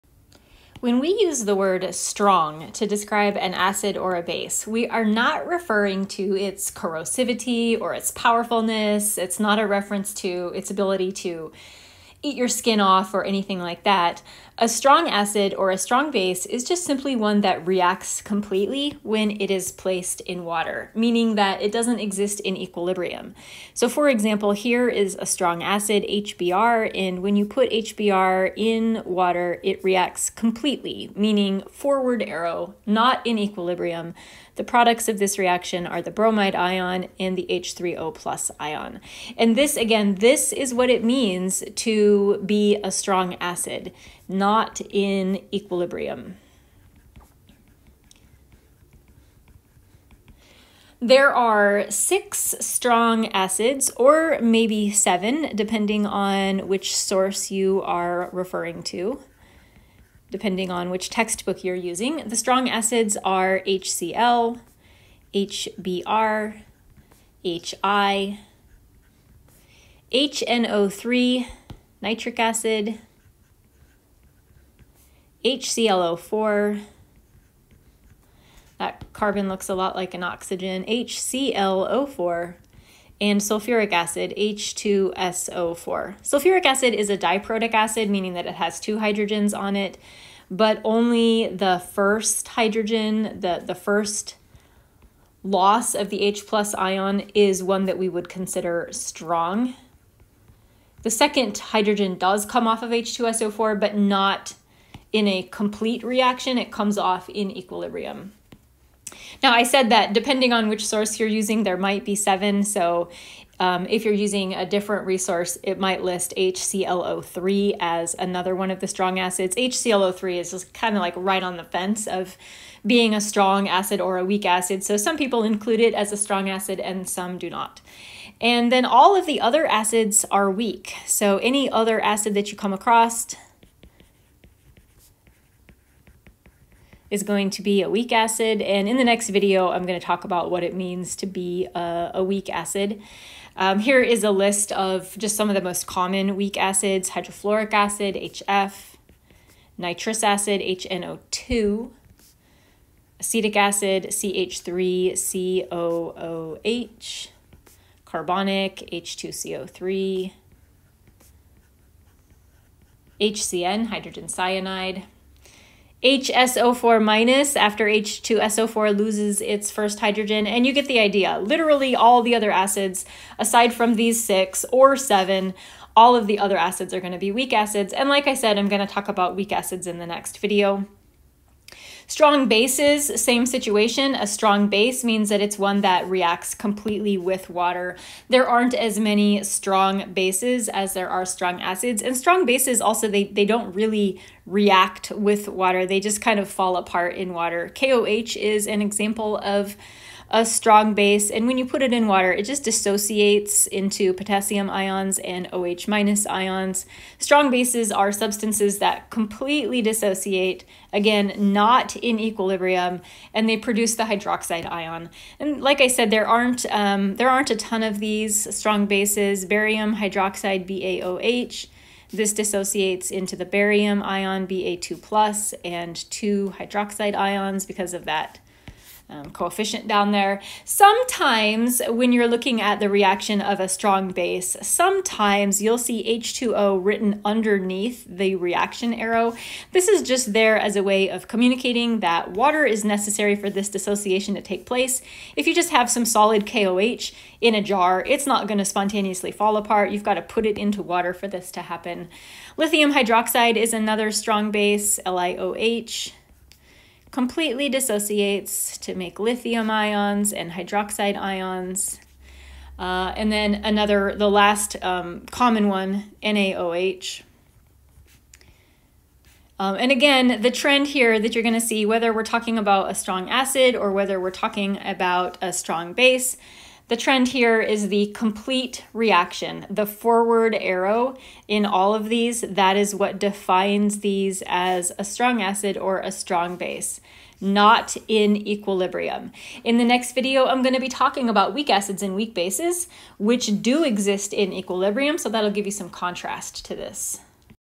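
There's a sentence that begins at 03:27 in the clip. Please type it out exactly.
Strong bases are substances that completely dissociate, again, not in equilibrium, and they produce the hydroxide ion.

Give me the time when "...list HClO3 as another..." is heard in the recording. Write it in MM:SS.
01:56.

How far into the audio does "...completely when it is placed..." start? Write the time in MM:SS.
00:18.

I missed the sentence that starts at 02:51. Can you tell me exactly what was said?
Literally, all the other acids, aside from these six or seven, all of the other acids are going to be weak acids.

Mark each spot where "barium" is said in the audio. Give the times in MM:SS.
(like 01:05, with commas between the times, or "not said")
03:39, 03:43.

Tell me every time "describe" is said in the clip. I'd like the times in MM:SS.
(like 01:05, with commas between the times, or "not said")
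00:02.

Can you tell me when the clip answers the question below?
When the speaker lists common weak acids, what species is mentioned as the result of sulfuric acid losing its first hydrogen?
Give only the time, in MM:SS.
02:46.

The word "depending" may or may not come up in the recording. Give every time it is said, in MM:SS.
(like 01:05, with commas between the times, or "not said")
00:55, 01:00, 01:50.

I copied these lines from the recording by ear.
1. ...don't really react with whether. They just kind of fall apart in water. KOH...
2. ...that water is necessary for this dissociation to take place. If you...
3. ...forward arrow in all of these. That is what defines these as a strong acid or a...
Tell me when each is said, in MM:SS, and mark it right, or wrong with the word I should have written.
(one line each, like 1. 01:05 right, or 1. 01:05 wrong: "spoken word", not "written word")
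1. 03:13 wrong: "water", not "whether"
2. 04:01 right
3. 04:39 right.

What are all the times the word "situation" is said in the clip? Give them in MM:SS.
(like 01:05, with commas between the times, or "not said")
03:03.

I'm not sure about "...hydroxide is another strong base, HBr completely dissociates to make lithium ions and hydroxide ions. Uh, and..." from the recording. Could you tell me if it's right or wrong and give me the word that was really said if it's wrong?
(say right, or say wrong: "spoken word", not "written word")
wrong: "LiOH", not "HBr".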